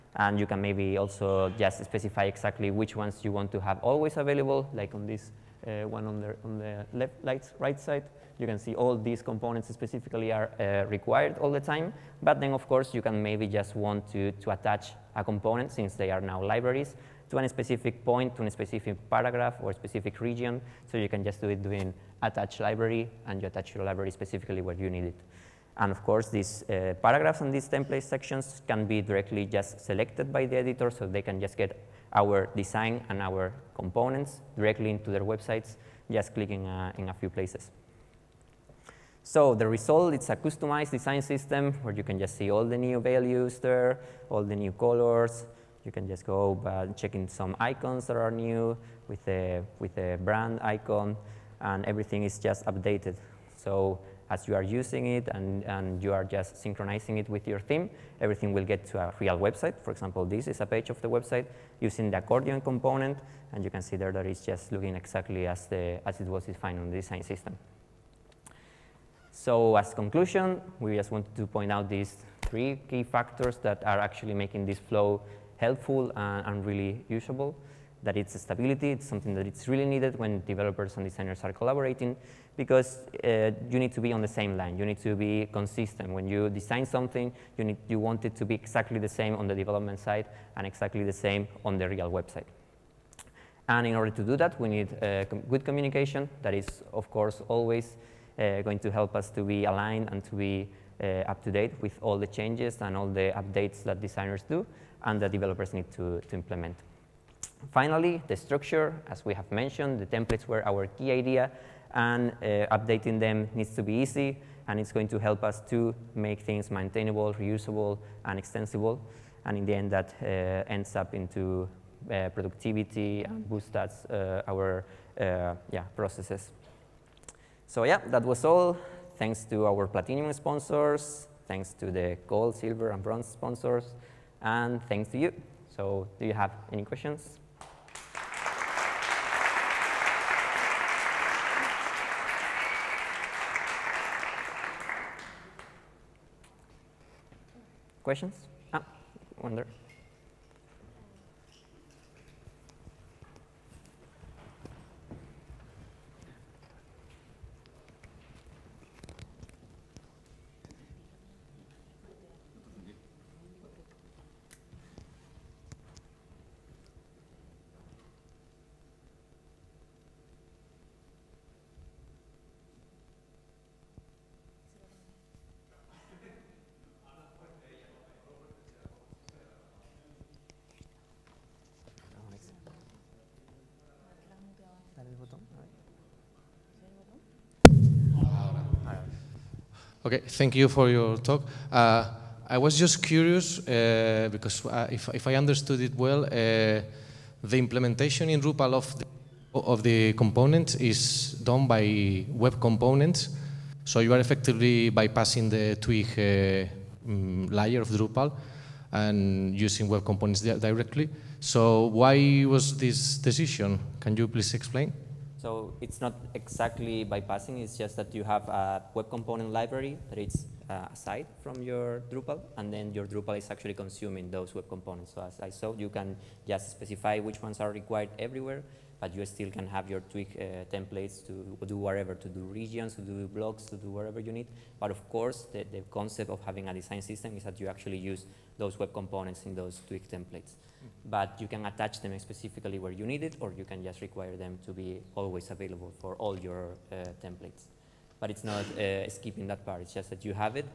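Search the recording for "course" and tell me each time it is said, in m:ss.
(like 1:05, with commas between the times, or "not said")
0:12, 0:26, 1:37, 3:55.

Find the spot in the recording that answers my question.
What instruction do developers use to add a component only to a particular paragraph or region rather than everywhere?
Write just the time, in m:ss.
0:22.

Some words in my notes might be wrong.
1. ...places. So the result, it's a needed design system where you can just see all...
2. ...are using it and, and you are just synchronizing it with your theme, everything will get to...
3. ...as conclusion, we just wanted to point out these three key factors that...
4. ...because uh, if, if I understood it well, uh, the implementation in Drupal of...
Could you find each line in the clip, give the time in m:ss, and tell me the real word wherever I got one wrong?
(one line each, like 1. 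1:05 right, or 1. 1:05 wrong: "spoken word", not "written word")
1. 0:37 wrong: "customized", not "needed"
2. 0:54 right
3. 1:09 right
4. 3:14 right.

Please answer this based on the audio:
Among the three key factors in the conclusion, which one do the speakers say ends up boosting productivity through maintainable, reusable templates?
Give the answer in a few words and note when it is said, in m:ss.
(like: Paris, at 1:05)
structure, at 1:48.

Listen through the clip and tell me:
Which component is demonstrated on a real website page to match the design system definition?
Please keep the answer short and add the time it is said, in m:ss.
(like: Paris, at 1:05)
accordion, at 1:02.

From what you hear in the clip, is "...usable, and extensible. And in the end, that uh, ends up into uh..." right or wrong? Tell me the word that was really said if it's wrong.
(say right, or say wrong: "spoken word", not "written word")
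wrong: "reusable", not "usable".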